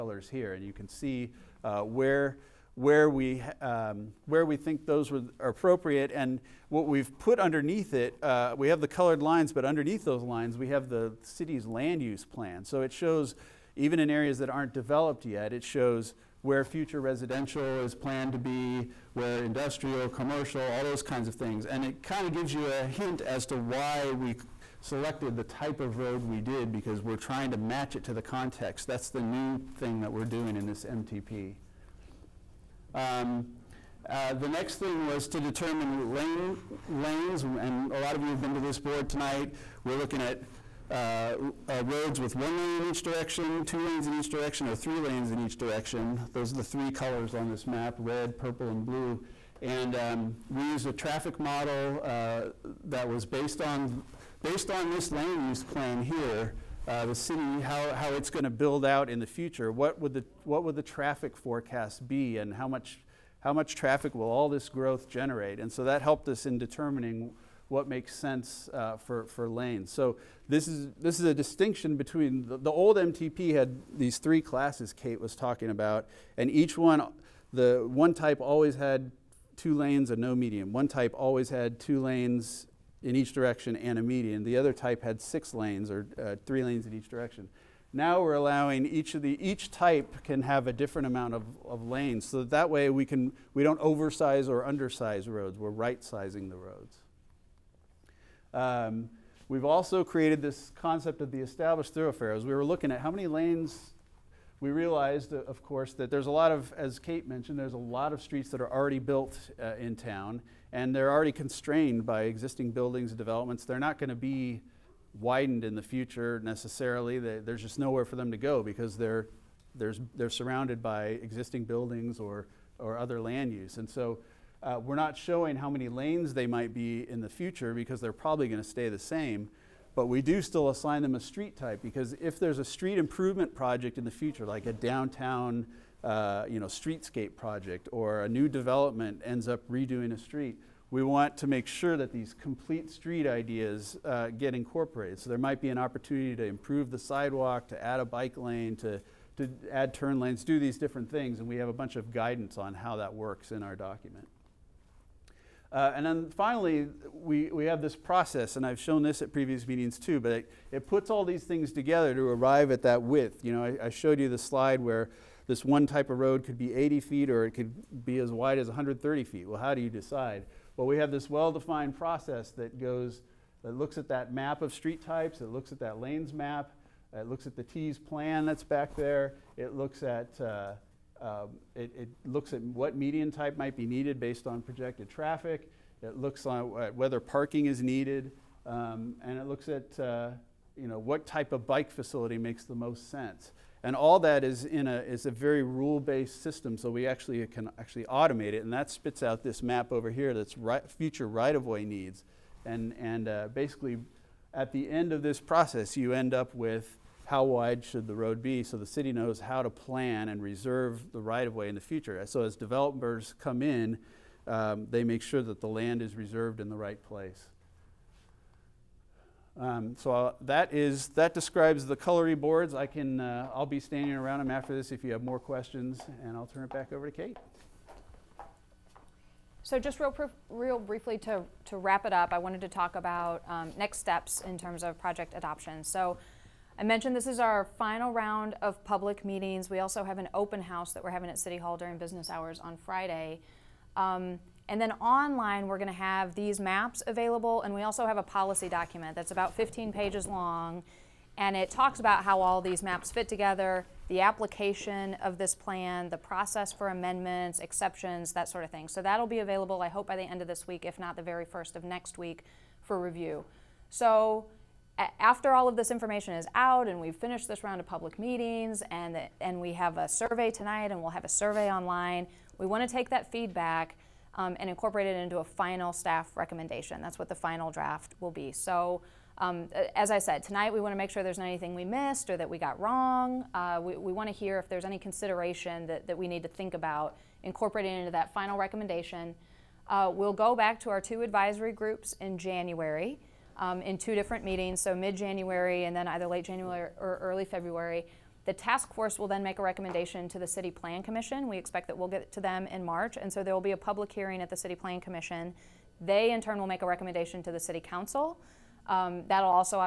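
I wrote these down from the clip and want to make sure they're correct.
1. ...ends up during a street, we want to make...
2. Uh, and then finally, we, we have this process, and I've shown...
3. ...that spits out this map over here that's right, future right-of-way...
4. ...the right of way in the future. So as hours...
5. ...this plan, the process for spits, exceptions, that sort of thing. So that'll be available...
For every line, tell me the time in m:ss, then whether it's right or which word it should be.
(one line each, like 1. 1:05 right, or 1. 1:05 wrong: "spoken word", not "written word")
1. 2:19 wrong: "redoing", not "during"
2. 2:35 right
3. 3:18 right
4. 3:31 wrong: "developers", not "hours"
5. 4:15 wrong: "amendments", not "spits".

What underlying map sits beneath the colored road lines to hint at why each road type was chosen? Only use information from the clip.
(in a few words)
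City's land use plan.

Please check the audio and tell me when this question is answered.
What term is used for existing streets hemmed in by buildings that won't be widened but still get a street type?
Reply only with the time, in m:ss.
1:41.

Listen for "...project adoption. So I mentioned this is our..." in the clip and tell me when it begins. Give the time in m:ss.
3:54.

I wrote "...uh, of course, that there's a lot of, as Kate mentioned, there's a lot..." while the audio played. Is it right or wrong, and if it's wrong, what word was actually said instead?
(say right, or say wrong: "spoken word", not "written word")
right.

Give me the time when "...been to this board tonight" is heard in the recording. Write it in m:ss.
0:38.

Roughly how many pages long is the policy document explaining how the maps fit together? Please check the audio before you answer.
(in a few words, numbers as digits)
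15.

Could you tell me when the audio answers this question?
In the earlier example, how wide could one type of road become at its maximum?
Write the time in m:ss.
2:48.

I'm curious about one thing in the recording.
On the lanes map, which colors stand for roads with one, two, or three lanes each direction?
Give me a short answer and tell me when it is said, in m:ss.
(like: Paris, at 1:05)
Red, purple, and blue, at 0:47.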